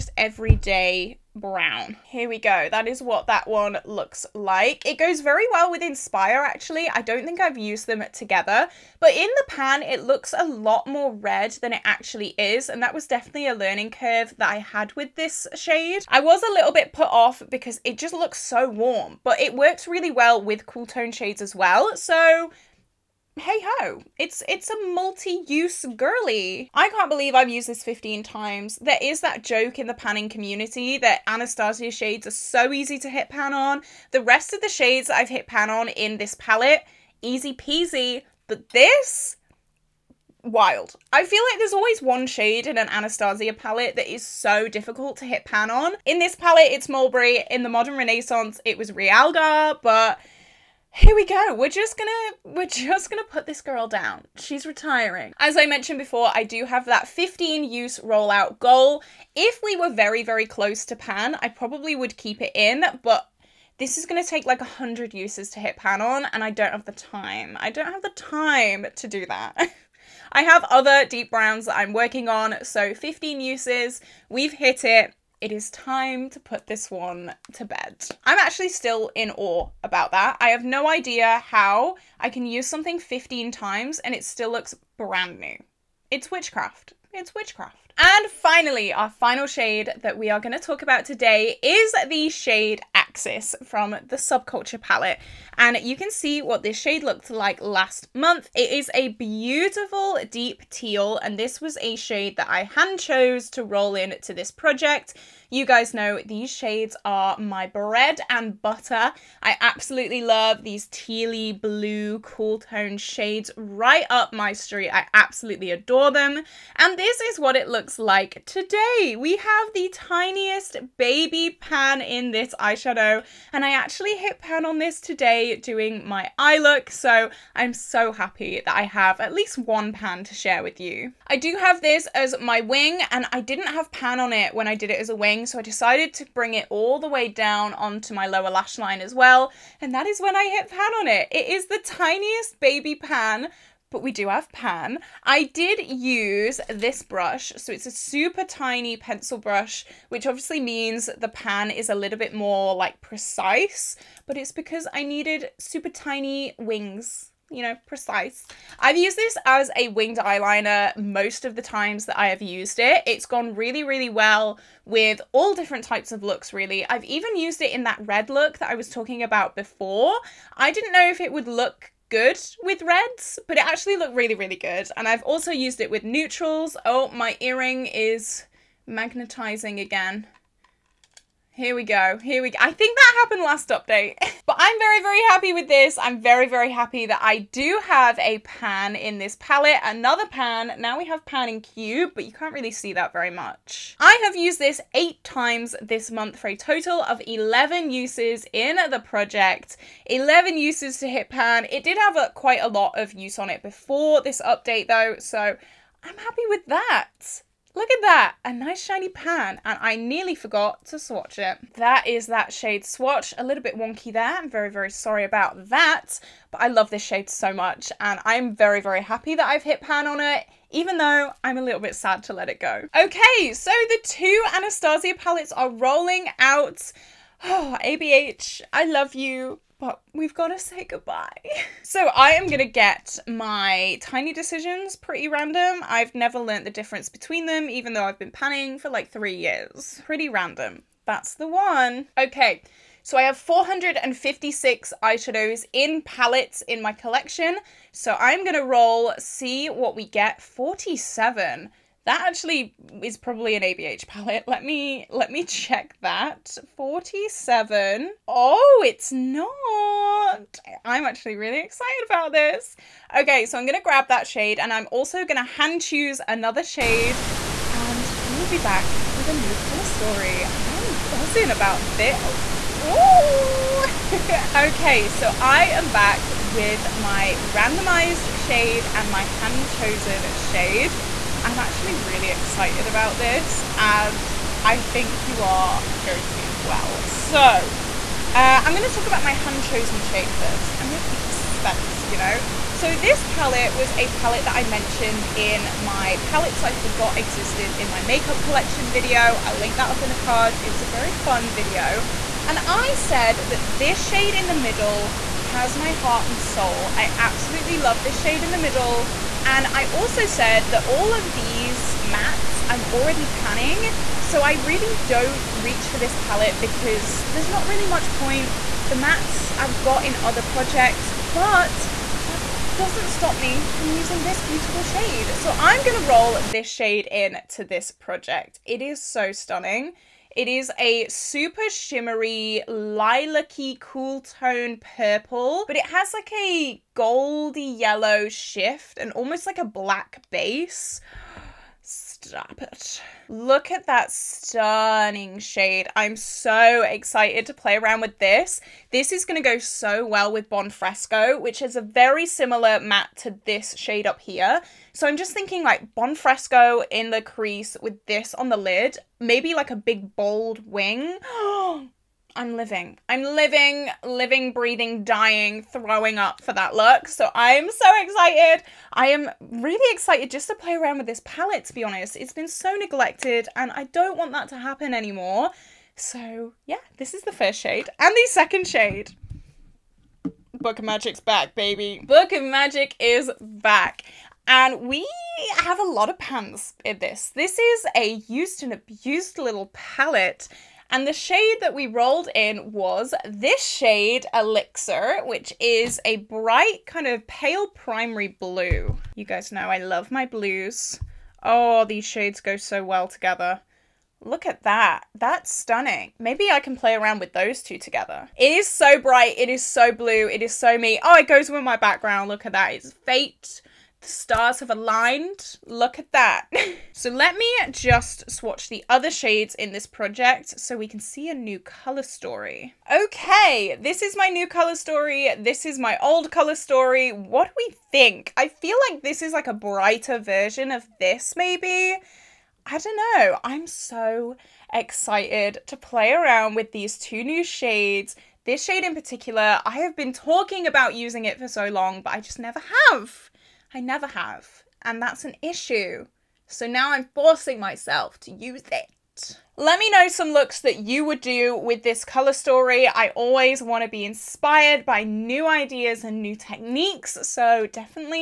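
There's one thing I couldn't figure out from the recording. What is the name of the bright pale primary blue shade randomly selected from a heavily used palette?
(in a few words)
Elixir.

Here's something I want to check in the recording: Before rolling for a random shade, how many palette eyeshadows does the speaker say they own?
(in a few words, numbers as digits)
456.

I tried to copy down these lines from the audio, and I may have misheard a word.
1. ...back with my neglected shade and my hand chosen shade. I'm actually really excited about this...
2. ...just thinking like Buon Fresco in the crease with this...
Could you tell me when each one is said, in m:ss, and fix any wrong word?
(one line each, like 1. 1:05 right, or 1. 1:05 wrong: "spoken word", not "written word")
1. 4:35 wrong: "randomized", not "neglected"
2. 5:55 right.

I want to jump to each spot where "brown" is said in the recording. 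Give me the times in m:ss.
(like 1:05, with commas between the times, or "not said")
0:01, 1:11.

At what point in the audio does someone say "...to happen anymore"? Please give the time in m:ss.
6:14.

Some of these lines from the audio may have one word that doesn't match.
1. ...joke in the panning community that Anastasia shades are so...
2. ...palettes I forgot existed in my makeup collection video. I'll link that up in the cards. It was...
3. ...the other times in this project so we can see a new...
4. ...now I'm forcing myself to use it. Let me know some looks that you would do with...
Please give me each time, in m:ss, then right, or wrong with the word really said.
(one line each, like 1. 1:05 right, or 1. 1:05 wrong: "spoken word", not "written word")
1. 0:29 right
2. 4:56 right
3. 6:58 wrong: "shades", not "times"
4. 7:26 right.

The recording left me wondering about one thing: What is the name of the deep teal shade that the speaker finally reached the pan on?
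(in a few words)
Axis.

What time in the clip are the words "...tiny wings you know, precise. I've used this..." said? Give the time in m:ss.
2:35.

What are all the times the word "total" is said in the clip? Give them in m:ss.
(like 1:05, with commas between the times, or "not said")
3:16.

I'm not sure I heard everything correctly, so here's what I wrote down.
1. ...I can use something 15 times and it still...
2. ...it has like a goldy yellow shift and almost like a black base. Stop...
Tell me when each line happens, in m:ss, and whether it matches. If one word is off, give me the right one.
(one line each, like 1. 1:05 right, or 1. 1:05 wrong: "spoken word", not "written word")
1. 1:22 right
2. 5:35 right.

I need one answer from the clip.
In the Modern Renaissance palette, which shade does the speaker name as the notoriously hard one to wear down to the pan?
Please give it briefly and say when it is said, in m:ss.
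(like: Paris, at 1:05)
Realgar, at 0:48.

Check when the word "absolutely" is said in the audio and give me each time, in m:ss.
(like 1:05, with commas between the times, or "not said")
1:49, 1:55, 5:07.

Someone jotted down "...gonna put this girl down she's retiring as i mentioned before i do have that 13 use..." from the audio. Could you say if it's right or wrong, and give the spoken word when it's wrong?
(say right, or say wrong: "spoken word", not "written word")
wrong: "15", not "13".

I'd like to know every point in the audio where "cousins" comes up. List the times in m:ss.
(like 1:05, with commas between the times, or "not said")
not said.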